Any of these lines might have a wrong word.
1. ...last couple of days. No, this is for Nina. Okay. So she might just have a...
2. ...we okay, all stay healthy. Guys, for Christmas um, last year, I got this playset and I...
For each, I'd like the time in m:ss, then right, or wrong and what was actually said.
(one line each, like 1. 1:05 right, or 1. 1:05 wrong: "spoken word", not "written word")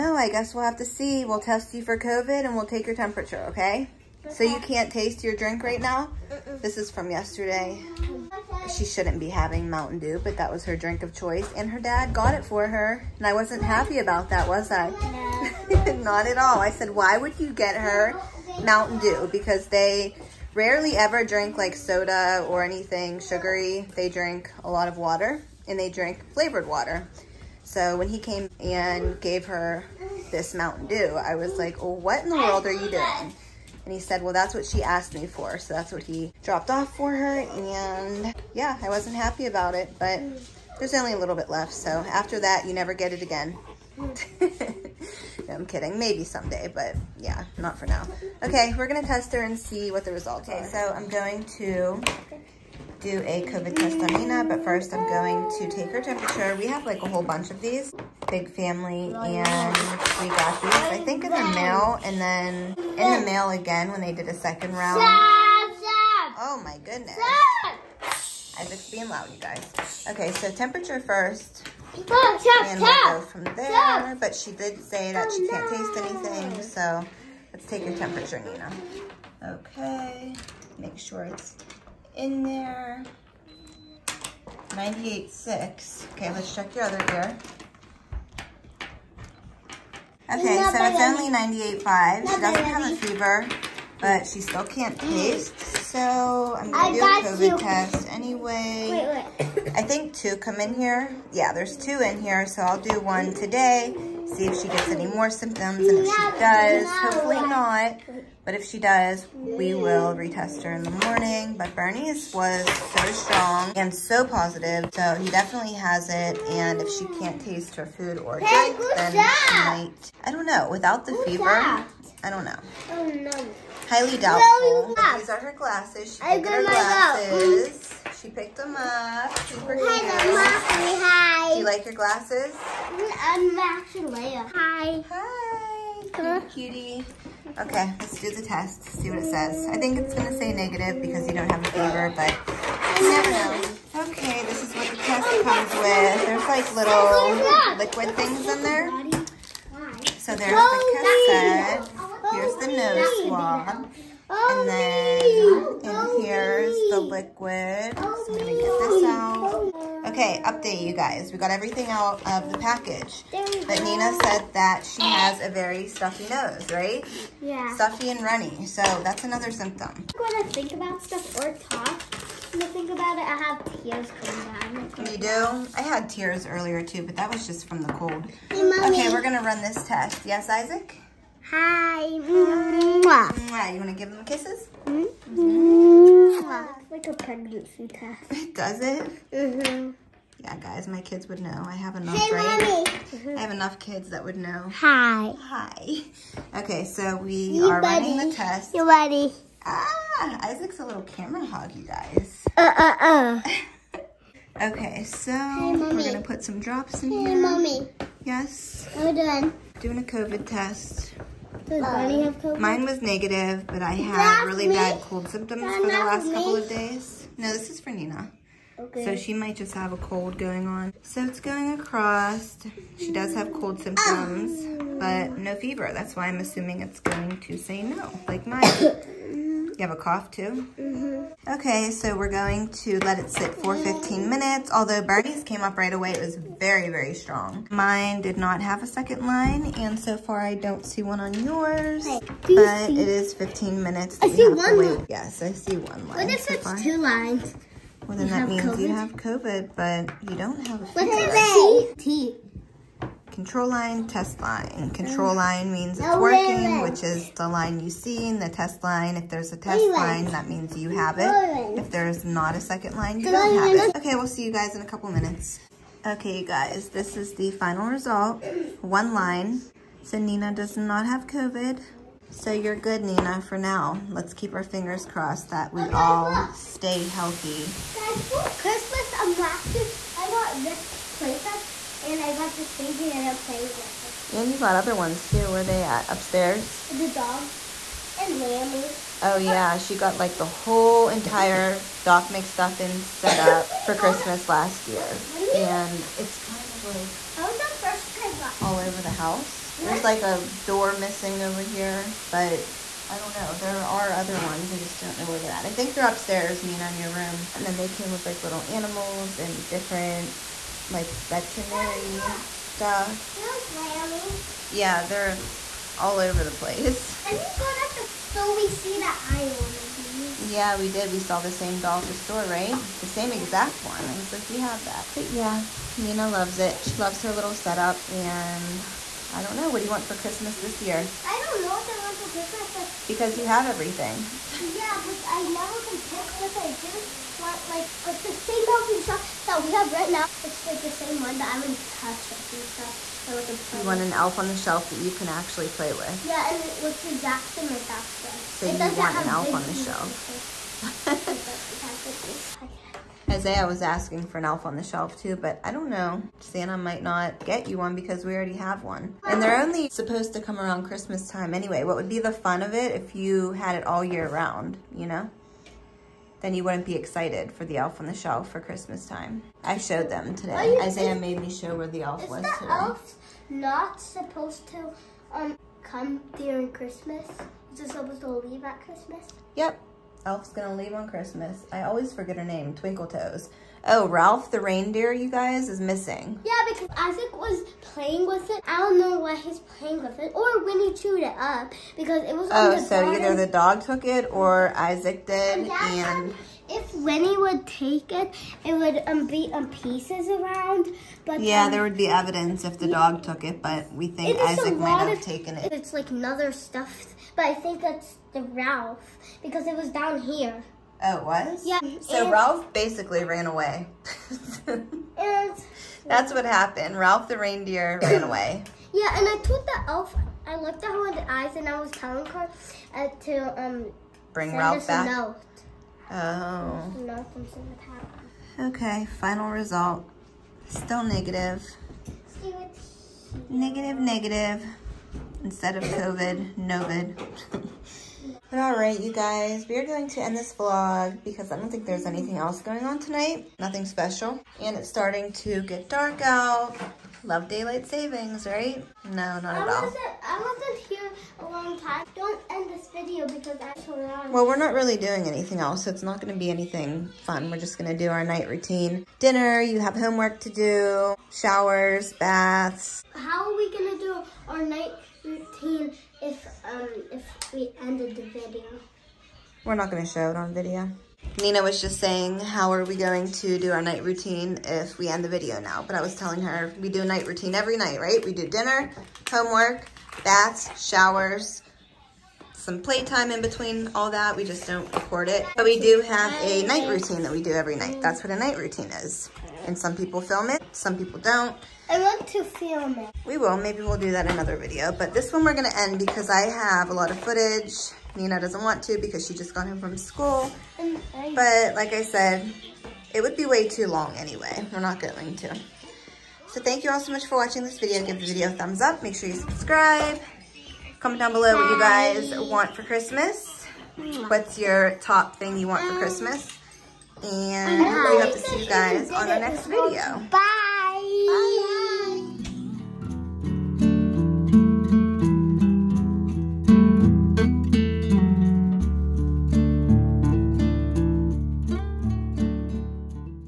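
1. 3:35 right
2. 4:35 right.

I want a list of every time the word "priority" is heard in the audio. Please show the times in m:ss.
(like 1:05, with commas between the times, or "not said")
not said.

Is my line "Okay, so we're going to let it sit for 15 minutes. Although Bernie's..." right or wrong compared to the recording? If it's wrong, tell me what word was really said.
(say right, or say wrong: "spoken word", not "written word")
right.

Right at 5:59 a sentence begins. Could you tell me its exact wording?
And they're only supposed to come around Christmas time anyway.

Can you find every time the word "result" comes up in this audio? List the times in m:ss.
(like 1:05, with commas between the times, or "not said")
0:50, 4:27, 7:09.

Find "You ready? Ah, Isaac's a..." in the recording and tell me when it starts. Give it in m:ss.
3:18.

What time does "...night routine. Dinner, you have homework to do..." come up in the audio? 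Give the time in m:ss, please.
7:38.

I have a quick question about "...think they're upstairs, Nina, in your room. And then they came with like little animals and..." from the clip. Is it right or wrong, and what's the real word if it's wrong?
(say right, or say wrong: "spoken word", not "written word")
right.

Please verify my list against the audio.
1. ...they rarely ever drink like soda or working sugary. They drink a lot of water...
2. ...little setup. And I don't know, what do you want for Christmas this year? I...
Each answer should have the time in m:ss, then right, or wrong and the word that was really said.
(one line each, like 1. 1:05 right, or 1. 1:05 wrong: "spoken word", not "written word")
1. 0:19 wrong: "anything", not "working"
2. 5:27 right.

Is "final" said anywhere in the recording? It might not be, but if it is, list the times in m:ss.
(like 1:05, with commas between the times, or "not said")
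4:27, 7:09.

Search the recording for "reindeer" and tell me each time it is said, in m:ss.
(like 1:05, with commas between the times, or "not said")
6:24, 6:57.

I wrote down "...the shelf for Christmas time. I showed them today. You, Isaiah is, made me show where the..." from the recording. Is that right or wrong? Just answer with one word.
right.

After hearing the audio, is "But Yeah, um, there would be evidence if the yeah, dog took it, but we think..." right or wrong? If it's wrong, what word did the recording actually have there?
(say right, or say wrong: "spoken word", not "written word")
right.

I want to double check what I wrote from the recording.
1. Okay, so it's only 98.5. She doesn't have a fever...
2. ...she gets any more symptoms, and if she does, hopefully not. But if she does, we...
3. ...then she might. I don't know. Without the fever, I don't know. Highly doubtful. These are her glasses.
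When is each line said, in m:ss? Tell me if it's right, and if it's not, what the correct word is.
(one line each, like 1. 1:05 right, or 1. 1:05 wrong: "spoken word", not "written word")
1. 1:30 right
2. 1:44 right
3. 1:58 right.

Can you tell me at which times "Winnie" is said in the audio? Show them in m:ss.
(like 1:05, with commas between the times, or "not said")
6:30, 6:36.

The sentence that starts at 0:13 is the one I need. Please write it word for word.
And I wasn't happy about that, was I?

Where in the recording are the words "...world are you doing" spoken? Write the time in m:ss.
0:32.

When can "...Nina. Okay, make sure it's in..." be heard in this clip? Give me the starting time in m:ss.
1:18.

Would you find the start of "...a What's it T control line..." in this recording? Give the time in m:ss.
4:10.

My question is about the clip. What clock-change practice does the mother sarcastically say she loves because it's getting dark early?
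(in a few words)
Daylight savings.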